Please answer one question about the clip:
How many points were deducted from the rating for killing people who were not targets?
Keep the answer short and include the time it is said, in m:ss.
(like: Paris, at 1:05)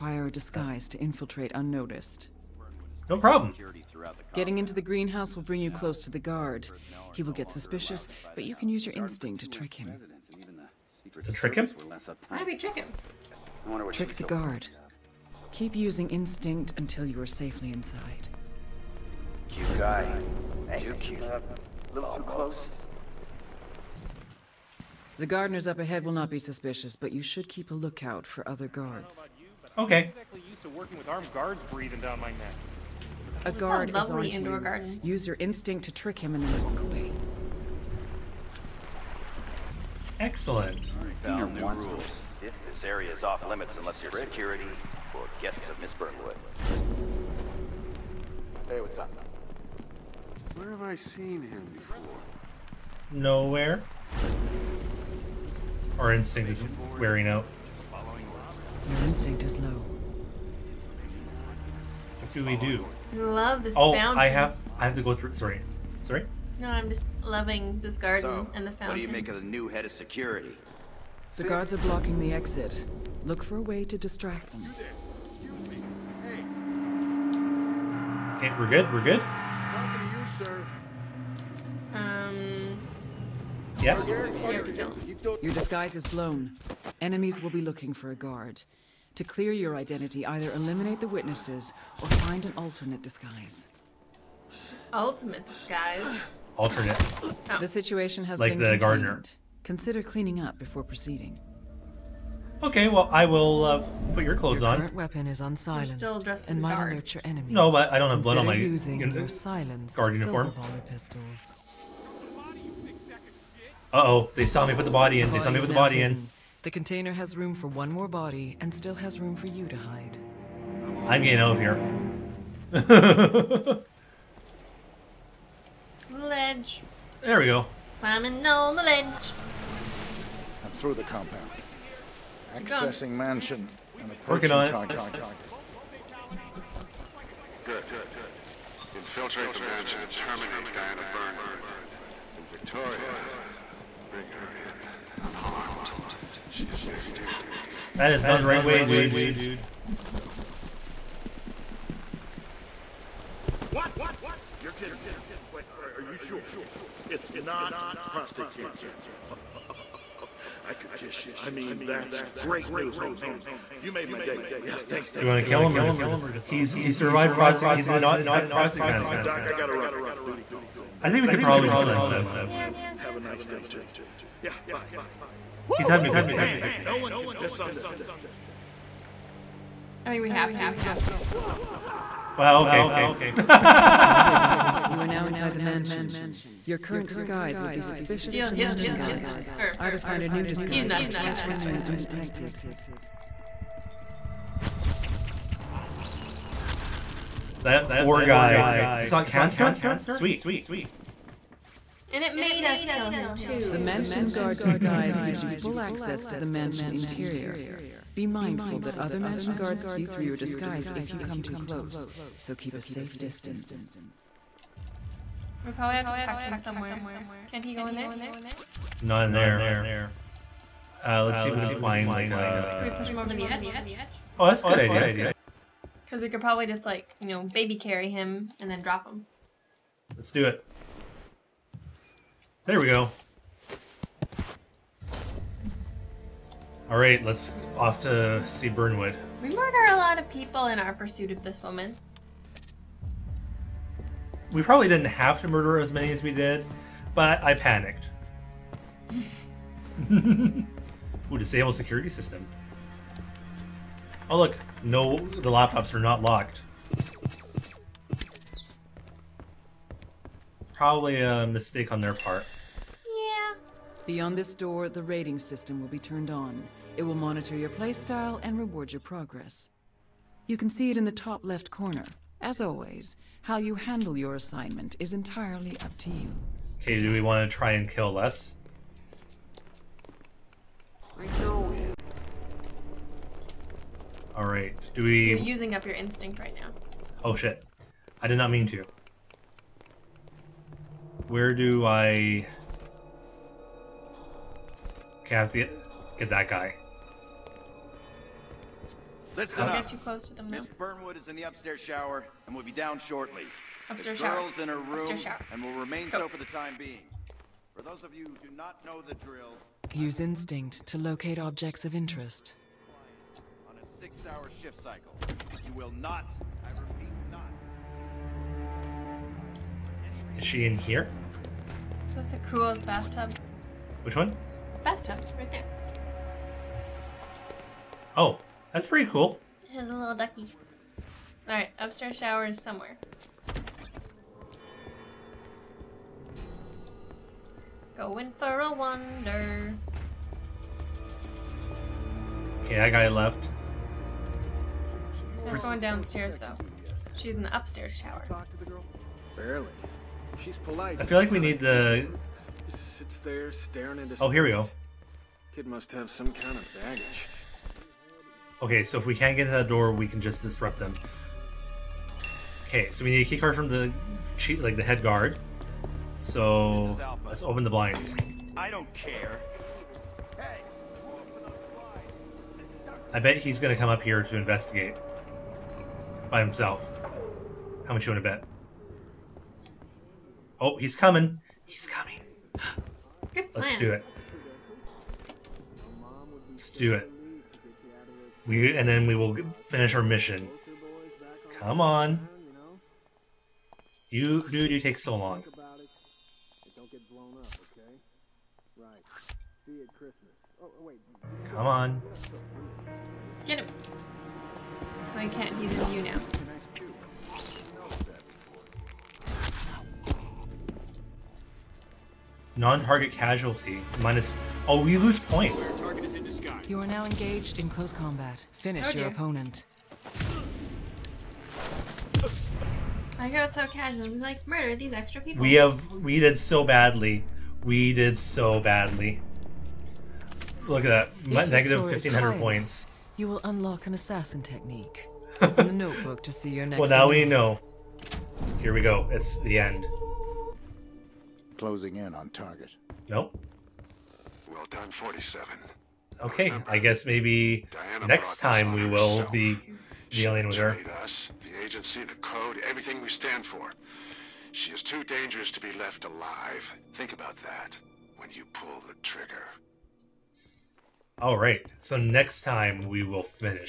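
1500, at 7:11.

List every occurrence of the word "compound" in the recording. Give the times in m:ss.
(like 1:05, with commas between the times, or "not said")
2:11.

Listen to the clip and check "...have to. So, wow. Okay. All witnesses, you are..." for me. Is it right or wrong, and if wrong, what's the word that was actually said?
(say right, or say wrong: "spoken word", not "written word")
right.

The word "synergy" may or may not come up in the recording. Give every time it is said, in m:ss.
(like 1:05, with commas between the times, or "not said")
not said.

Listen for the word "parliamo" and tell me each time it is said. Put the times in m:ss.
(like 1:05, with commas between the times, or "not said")
not said.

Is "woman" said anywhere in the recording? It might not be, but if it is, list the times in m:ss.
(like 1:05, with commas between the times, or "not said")
4:01.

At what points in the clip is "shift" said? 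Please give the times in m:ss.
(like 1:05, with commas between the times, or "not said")
5:14.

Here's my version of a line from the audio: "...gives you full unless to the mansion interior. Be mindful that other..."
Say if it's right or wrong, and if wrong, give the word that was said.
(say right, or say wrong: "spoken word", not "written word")
wrong: "access", not "unless".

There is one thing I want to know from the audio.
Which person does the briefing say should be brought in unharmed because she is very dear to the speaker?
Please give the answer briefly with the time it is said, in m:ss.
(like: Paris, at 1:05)
Victoria, at 2:22.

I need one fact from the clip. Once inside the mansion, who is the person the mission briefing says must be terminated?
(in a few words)
Diana Burnwood.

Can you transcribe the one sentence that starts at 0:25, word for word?
The gardeners up ahead will not be suspicious, but you should keep a lookout for other guards.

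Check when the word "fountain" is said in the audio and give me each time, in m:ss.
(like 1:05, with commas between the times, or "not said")
1:03, 1:08.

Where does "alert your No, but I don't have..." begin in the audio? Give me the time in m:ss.
1:46.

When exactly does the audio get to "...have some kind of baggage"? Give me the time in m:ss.
5:55.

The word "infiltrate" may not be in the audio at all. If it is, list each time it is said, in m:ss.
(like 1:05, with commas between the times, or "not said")
0:00, 2:18.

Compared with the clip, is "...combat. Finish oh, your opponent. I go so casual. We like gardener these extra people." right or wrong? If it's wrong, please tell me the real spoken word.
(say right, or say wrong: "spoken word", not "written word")
wrong: "murder", not "gardener".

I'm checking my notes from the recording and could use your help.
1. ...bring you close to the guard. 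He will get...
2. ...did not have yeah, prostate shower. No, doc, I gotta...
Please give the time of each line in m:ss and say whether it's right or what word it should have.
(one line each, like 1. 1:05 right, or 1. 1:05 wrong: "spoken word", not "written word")
1. 0:05 right
2. 2:47 wrong: "cancer", not "shower".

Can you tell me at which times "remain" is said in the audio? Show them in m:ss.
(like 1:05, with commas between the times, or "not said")
3:11, 5:05.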